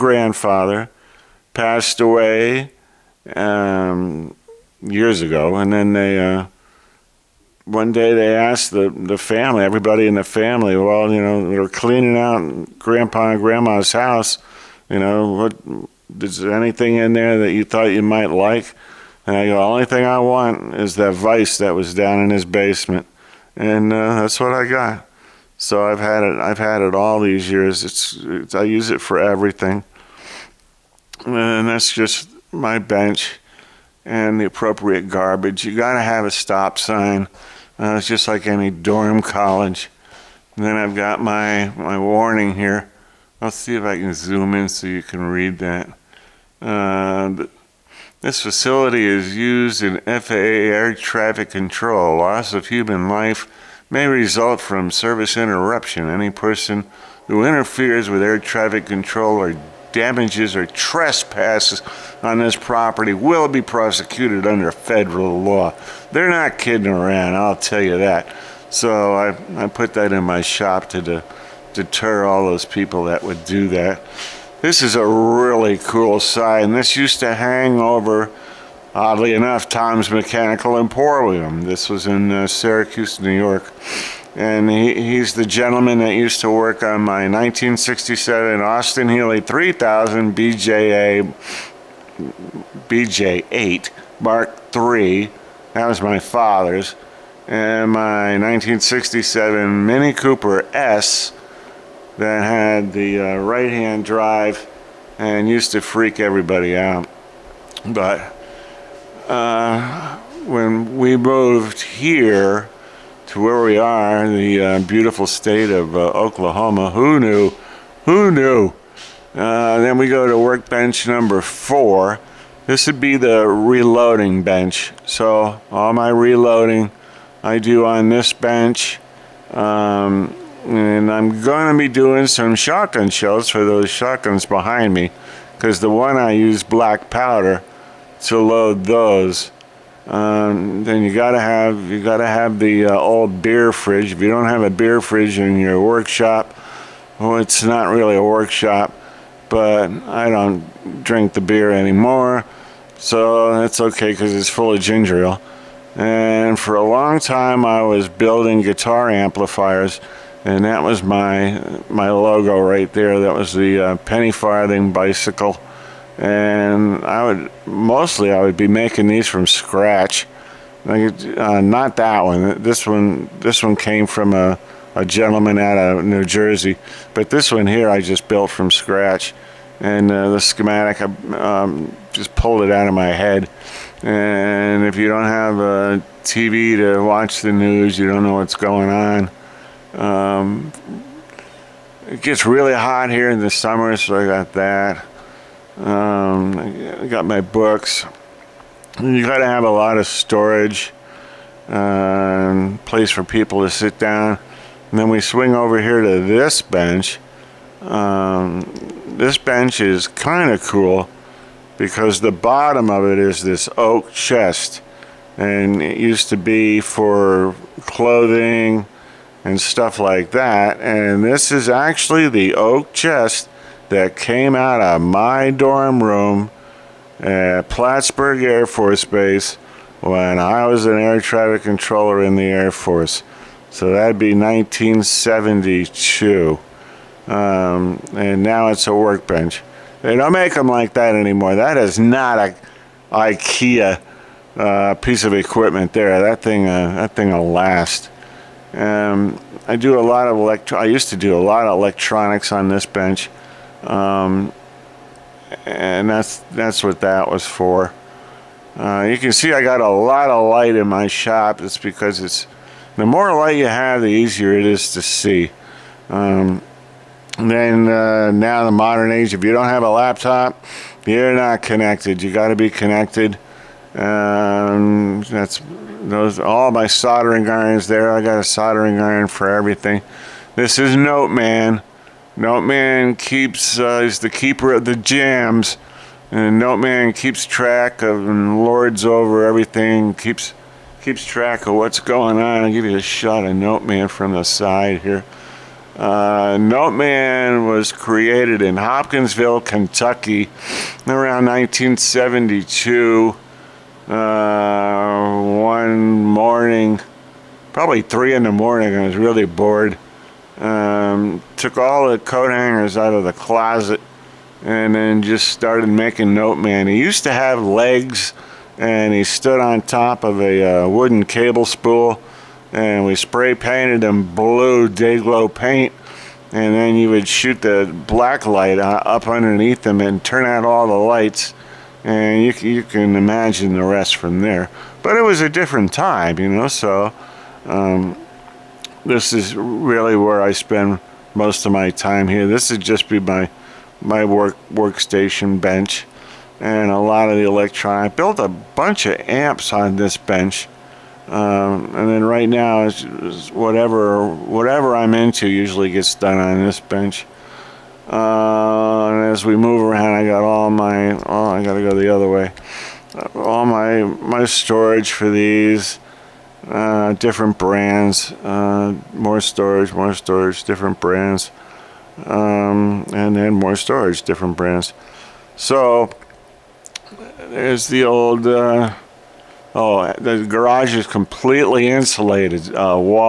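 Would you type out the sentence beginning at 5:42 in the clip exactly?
This would just be my my work workstation bench and a lot of the electronics.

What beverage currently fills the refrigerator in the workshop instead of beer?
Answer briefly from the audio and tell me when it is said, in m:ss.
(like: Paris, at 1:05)
Ginger ale, at 2:34.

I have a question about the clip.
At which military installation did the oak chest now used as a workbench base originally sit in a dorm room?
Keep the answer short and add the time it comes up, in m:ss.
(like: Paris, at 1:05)
Plattsburgh Air Force Base, at 3:47.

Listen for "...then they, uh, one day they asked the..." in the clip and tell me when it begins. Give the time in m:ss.
0:05.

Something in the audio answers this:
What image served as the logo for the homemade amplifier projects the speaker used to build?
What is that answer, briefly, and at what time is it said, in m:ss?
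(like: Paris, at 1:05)
Penny farthing bicycle, at 2:43.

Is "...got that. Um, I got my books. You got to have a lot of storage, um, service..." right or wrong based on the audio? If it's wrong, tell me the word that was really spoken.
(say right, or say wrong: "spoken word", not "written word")
wrong: "place", not "service".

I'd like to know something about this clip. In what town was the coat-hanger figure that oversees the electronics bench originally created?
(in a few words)
Hopkinsville, Kentucky.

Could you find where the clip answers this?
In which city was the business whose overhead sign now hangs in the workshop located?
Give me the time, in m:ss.
1:22.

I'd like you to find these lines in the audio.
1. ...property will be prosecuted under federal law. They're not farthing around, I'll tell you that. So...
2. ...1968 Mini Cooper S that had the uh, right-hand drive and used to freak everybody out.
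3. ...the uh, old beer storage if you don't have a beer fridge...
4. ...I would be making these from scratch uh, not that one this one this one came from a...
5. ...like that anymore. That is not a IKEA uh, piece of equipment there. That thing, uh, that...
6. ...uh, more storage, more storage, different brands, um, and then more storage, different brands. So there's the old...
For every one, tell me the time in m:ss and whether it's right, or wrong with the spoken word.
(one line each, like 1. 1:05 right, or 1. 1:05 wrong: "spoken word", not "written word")
1. 1:02 wrong: "kidding", not "farthing"
2. 1:38 wrong: "1967", not "1968"
3. 2:22 wrong: "fridge", not "storage"
4. 2:48 right
5. 4:00 right
6. 6:08 right.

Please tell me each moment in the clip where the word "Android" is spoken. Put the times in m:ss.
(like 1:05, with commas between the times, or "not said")
not said.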